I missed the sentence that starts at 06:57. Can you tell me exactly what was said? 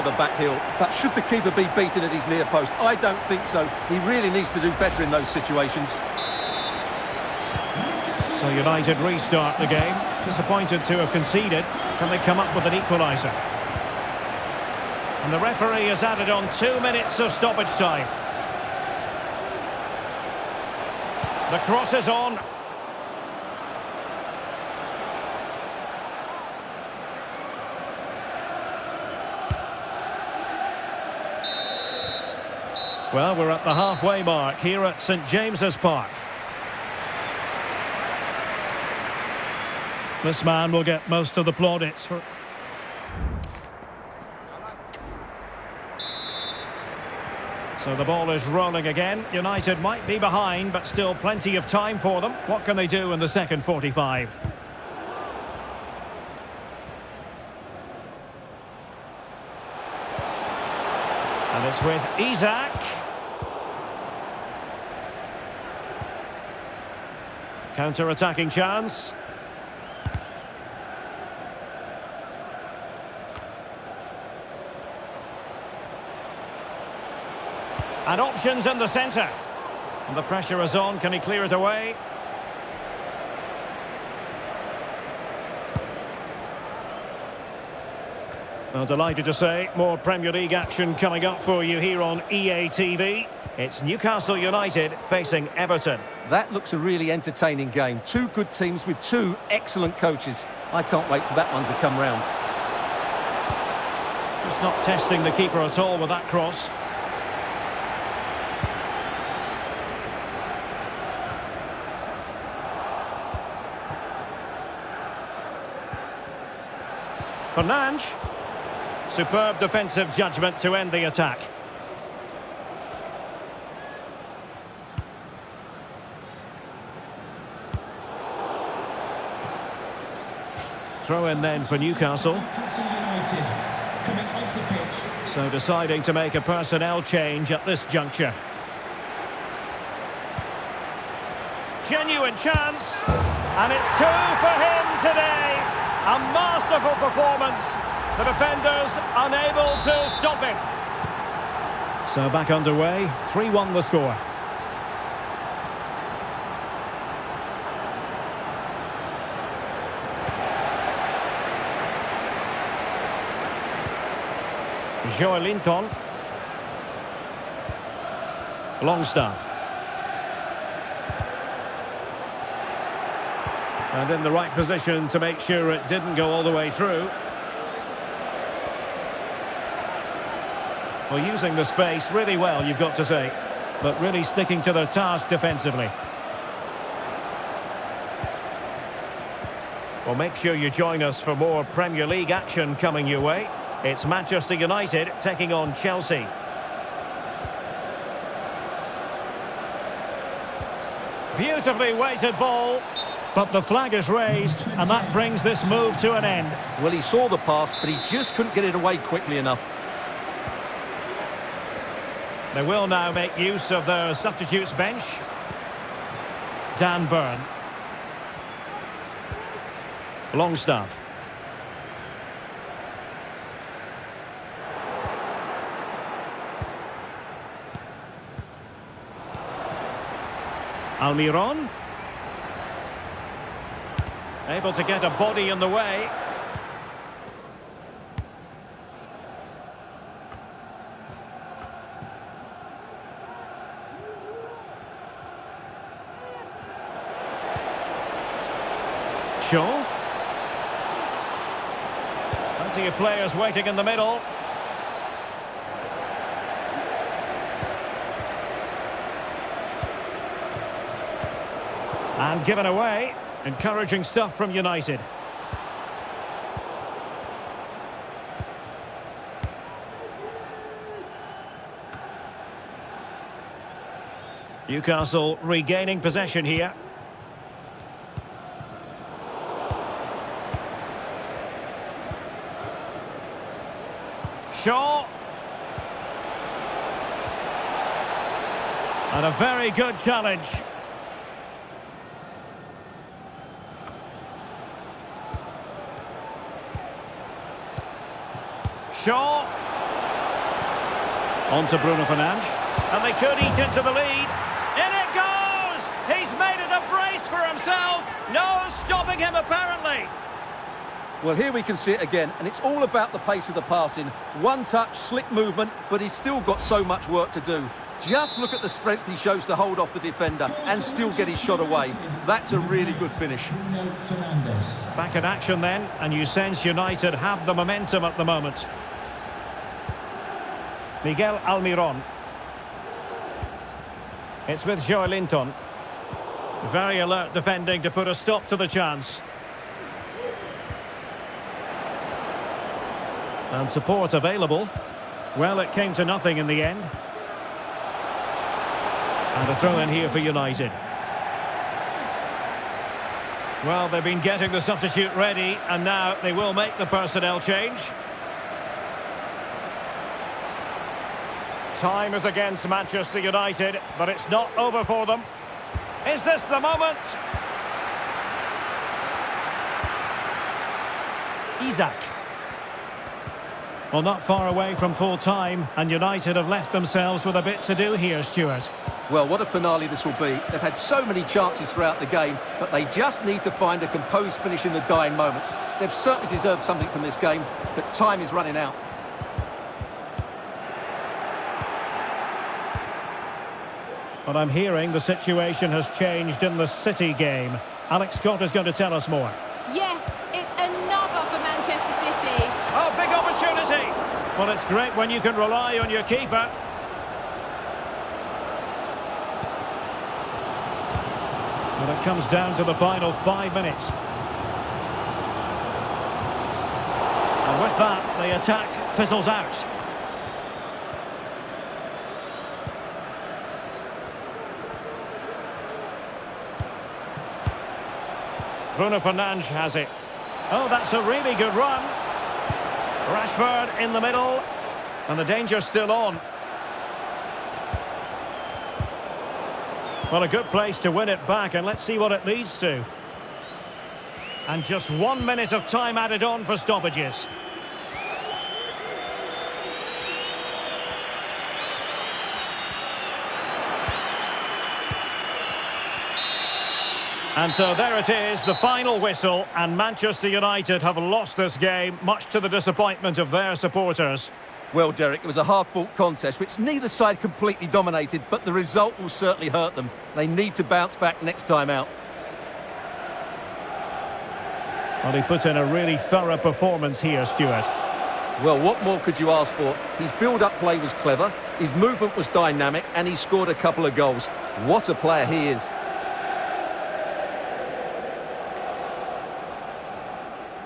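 And with that, the attack fizzles out.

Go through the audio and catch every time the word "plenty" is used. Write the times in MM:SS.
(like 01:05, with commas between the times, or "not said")
00:51, 04:12.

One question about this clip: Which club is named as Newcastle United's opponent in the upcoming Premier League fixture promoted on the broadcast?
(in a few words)
Everton.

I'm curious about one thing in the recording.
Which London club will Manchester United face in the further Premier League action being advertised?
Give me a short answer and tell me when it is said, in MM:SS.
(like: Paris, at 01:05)
Chelsea, at 03:15.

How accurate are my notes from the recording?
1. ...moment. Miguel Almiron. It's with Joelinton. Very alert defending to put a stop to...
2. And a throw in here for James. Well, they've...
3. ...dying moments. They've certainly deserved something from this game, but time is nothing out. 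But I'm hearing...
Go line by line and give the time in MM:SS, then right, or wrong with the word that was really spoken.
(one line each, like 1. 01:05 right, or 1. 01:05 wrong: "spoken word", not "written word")
1. 05:28 right
2. 05:46 wrong: "United", not "James"
3. 06:24 wrong: "running", not "nothing".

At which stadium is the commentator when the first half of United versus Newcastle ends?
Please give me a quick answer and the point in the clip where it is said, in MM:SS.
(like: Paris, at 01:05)
St James's Park, at 00:35.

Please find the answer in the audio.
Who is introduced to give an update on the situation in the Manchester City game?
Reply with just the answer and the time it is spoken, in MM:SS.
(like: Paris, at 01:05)
Alex Scott, at 06:37.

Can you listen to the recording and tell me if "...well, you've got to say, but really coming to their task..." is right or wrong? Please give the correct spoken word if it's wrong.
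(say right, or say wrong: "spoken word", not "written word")
wrong: "sticking", not "coming".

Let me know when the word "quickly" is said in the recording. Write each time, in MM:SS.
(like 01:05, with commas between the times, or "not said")
03:28.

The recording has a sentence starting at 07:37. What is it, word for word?
And so there it is, the final whistle, and Manchester United have lost this game, much to the disappointment of their supporters.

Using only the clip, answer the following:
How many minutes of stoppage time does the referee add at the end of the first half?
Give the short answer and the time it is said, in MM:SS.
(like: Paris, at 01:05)
2, at 00:16.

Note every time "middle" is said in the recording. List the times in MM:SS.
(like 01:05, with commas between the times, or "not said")
04:13, 07:14.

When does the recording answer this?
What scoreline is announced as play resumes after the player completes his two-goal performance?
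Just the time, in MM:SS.
02:33.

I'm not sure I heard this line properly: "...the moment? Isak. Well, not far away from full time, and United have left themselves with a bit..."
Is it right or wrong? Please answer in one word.
right.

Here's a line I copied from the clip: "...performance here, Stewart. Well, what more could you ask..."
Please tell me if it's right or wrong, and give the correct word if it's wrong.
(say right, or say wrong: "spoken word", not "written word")
right.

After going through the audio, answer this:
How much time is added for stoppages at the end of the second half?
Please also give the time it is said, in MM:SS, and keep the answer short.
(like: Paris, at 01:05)
1 minute, at 07:24.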